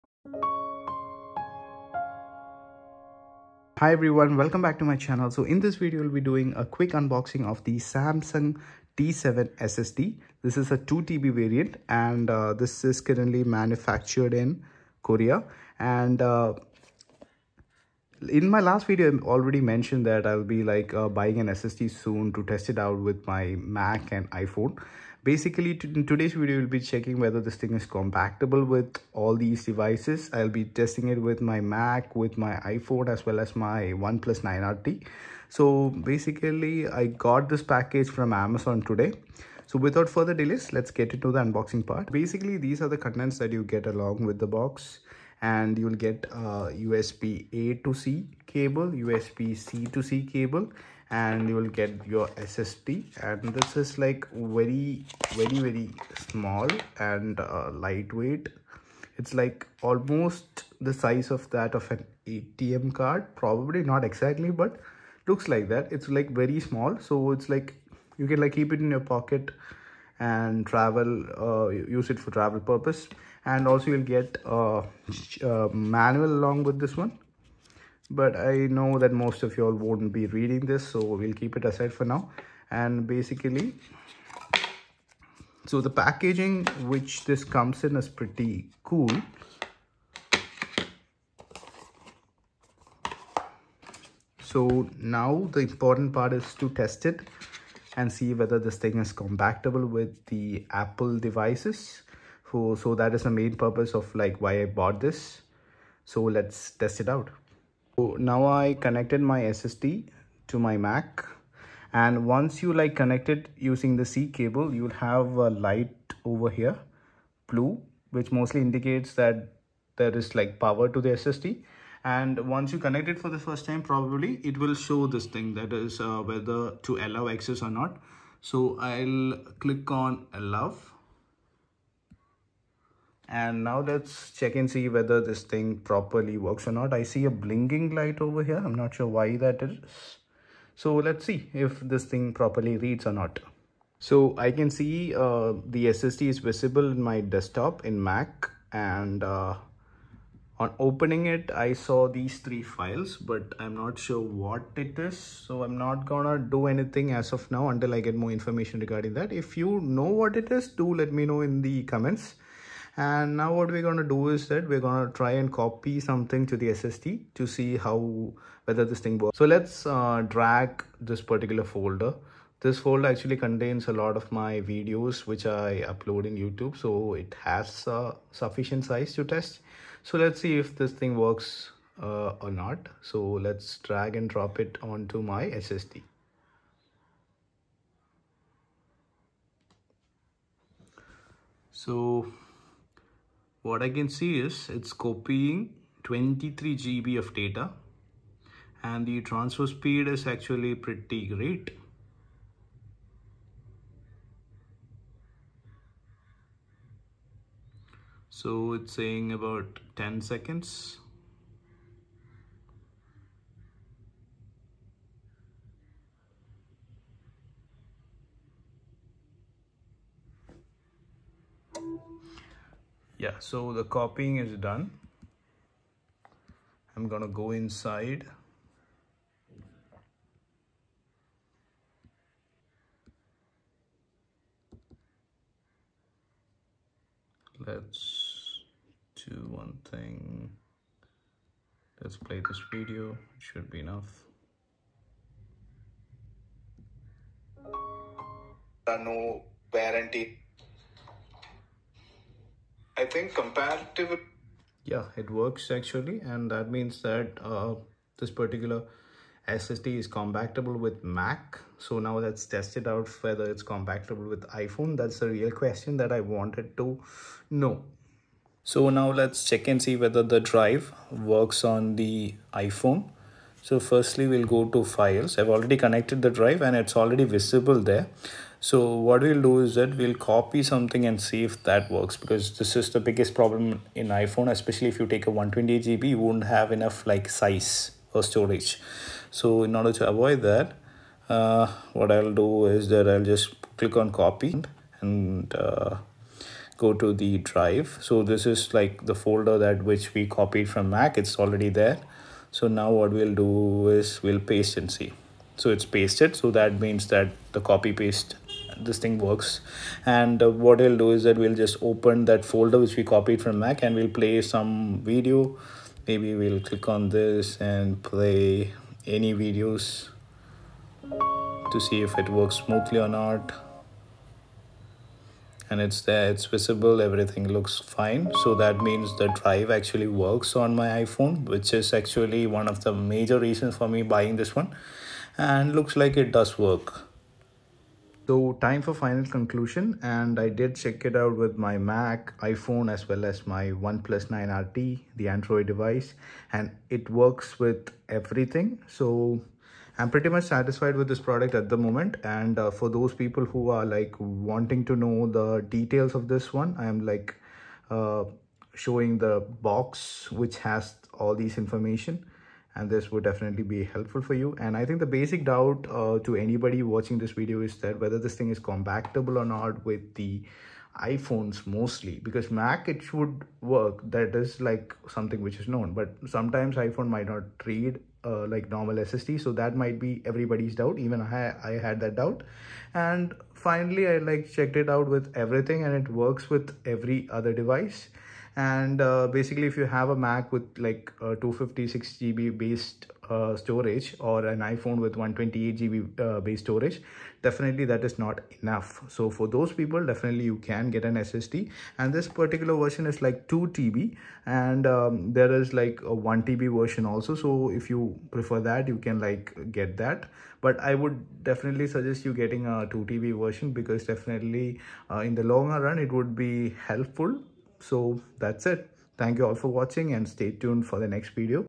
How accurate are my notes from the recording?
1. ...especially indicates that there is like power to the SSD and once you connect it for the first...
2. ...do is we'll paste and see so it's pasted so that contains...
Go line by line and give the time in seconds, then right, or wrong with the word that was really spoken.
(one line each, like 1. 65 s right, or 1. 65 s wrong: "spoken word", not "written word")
1. 118 s wrong: "mostly", not "especially"
2. 303 s wrong: "means", not "contains".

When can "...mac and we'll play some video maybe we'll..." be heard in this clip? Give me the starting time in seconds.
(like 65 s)
313 s.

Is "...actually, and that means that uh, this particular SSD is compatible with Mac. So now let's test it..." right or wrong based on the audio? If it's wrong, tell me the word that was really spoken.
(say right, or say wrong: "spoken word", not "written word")
right.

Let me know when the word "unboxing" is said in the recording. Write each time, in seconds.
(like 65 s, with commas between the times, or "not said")
6 s, 41 s.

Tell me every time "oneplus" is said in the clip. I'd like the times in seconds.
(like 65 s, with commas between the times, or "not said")
34 s, 343 s.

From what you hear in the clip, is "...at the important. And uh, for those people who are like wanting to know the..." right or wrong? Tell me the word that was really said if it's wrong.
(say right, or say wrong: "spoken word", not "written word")
wrong: "moment", not "important".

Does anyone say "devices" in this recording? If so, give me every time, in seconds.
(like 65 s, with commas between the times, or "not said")
29 s, 101 s, 345 s, 387 s.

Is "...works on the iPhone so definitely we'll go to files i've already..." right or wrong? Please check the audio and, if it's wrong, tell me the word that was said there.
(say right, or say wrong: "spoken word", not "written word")
wrong: "firstly", not "definitely".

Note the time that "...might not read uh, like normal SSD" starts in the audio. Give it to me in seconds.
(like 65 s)
377 s.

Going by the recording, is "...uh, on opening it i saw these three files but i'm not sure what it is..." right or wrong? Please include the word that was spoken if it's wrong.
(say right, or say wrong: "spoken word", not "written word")
right.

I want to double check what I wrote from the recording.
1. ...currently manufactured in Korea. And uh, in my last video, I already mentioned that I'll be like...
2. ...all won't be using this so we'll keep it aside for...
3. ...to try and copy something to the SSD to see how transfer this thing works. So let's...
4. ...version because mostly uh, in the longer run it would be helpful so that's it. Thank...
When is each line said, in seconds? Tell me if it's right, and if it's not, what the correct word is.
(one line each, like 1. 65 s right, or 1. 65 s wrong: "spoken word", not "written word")
1. 13 s right
2. 79 s wrong: "reading", not "using"
3. 165 s wrong: "whether", not "transfer"
4. 413 s wrong: "definitely", not "mostly".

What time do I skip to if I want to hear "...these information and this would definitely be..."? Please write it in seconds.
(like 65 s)
361 s.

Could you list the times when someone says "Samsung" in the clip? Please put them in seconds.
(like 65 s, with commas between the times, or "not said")
7 s.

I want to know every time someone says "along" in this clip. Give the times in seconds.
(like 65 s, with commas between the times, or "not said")
43 s, 76 s.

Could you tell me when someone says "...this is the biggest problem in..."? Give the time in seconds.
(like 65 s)
282 s.